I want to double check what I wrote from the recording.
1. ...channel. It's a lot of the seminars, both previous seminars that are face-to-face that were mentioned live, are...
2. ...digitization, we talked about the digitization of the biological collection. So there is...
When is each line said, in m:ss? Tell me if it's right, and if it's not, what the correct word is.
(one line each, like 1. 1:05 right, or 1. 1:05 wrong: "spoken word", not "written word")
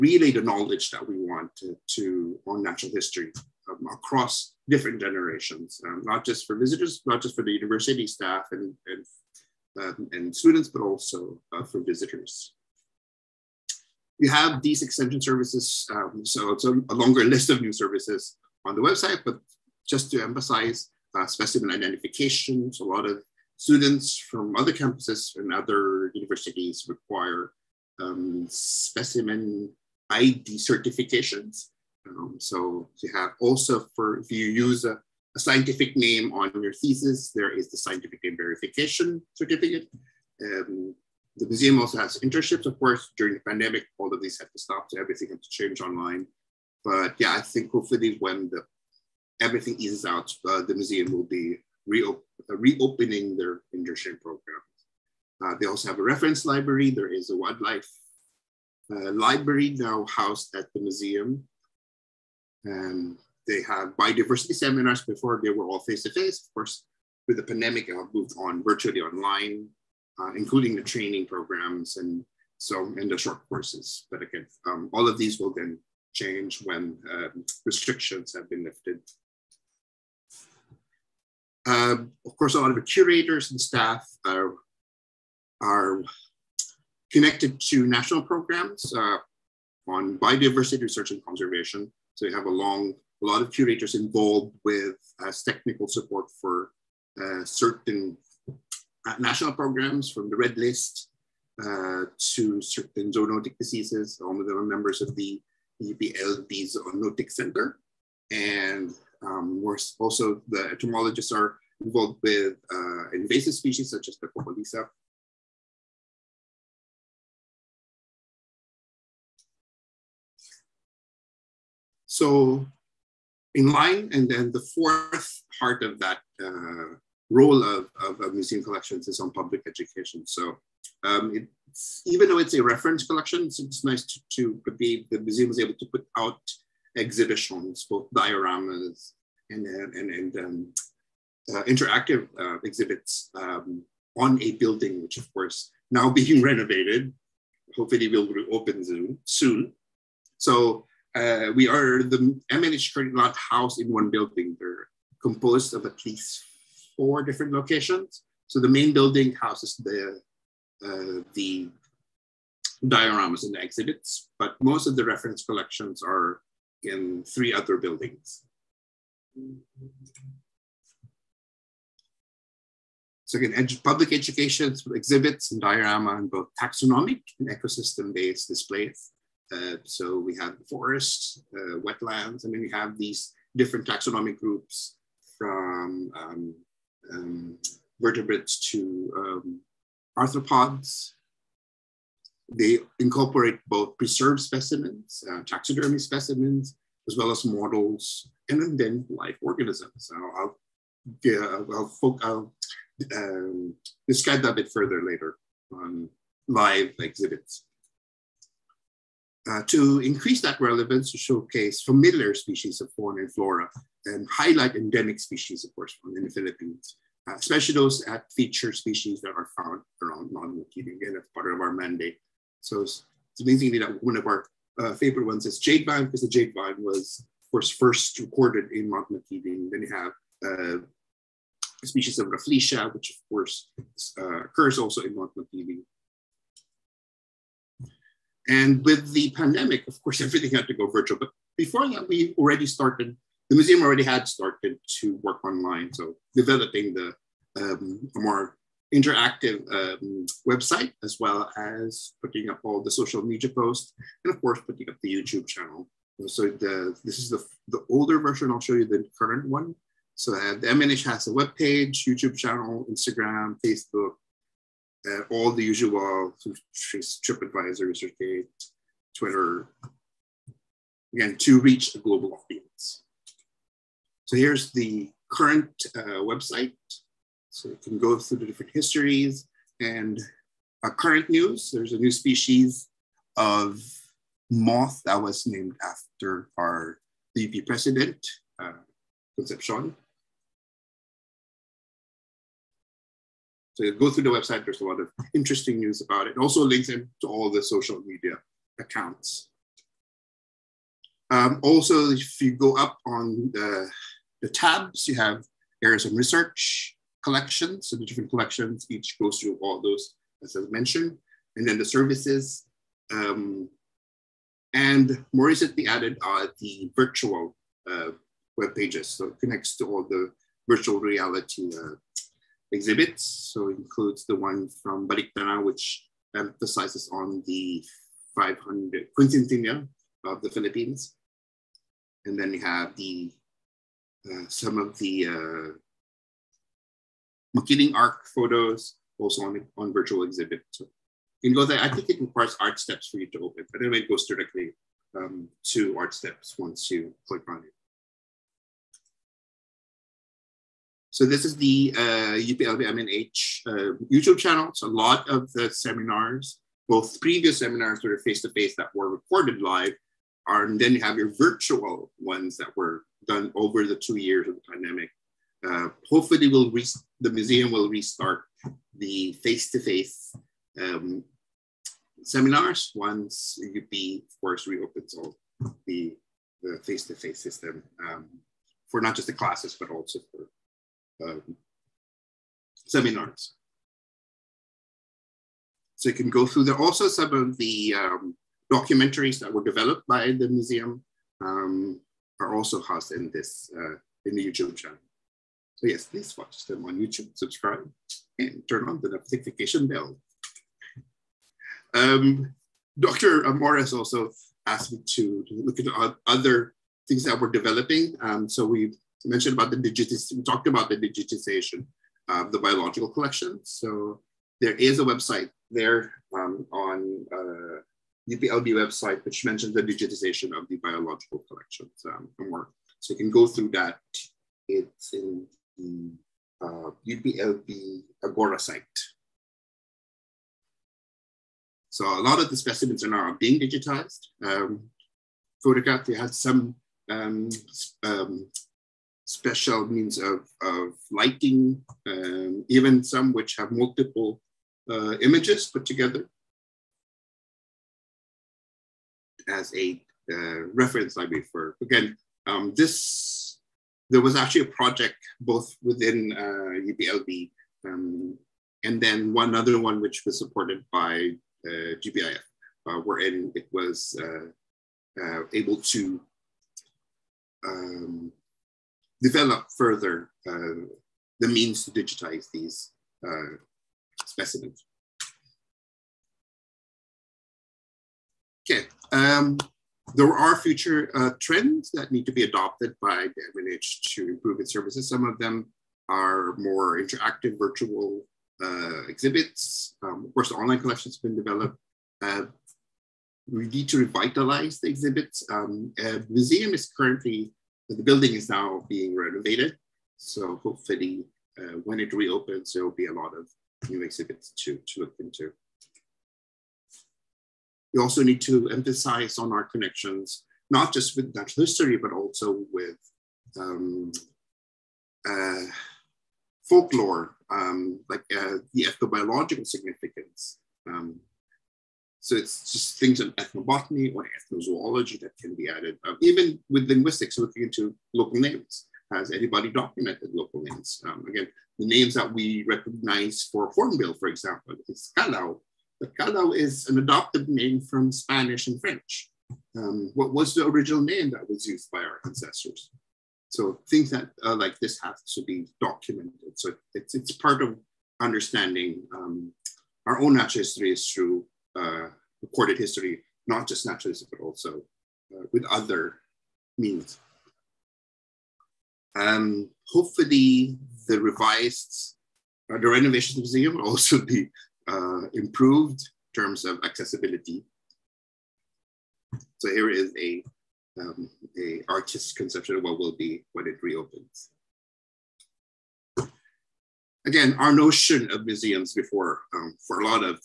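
1. 5:54 wrong: "recorded", not "mentioned"
2. 6:49 right.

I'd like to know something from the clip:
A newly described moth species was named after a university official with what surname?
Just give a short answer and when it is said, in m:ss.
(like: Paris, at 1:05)
Concepcion, at 4:49.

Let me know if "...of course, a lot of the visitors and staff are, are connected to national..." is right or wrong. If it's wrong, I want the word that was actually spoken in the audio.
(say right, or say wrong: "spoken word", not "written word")
wrong: "curators", not "visitors".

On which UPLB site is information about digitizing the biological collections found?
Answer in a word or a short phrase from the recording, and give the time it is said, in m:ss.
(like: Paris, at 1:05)
UPLB Agora, at 7:07.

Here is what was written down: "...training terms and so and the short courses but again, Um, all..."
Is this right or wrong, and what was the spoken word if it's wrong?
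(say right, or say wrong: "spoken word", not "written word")
wrong: "programs", not "terms".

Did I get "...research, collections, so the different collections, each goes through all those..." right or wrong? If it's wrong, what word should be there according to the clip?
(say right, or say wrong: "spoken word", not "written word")
right.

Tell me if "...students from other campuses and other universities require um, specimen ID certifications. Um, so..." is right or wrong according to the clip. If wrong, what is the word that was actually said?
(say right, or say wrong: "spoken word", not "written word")
right.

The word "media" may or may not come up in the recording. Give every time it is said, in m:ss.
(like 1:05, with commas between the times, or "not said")
4:13, 4:58.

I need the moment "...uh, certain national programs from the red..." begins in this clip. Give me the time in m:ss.
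1:37.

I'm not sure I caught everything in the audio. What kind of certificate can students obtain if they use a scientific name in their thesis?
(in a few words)
Scientific name verification certificate.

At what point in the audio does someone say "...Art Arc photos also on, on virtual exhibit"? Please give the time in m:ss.
5:37.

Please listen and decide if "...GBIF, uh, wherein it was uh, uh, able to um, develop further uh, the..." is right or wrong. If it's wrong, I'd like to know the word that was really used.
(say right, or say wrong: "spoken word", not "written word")
right.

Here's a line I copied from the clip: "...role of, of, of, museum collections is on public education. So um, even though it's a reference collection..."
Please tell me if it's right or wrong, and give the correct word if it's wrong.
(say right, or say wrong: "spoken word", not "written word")
right.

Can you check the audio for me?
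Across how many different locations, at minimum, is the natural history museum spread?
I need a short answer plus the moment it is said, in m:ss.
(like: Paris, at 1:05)
4, at 2:37.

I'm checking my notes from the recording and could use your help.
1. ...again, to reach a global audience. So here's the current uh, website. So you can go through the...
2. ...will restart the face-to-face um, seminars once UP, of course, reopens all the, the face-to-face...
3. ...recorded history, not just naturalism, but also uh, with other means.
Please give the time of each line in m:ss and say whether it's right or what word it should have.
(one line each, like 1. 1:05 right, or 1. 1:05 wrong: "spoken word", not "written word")
1. 4:31 right
2. 6:07 right
3. 9:12 right.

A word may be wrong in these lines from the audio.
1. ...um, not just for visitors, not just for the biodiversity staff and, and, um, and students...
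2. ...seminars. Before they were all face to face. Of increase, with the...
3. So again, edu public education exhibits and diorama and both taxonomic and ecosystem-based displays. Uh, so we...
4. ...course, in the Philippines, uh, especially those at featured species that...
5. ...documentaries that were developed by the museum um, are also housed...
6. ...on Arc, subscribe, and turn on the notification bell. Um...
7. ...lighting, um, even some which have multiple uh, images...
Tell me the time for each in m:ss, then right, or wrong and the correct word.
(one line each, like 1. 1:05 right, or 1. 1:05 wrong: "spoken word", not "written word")
1. 0:05 wrong: "university", not "biodiversity"
2. 1:04 wrong: "course", not "increase"
3. 2:53 right
4. 3:35 right
5. 6:28 right
6. 6:36 wrong: "YouTube", not "Arc"
7. 7:21 right.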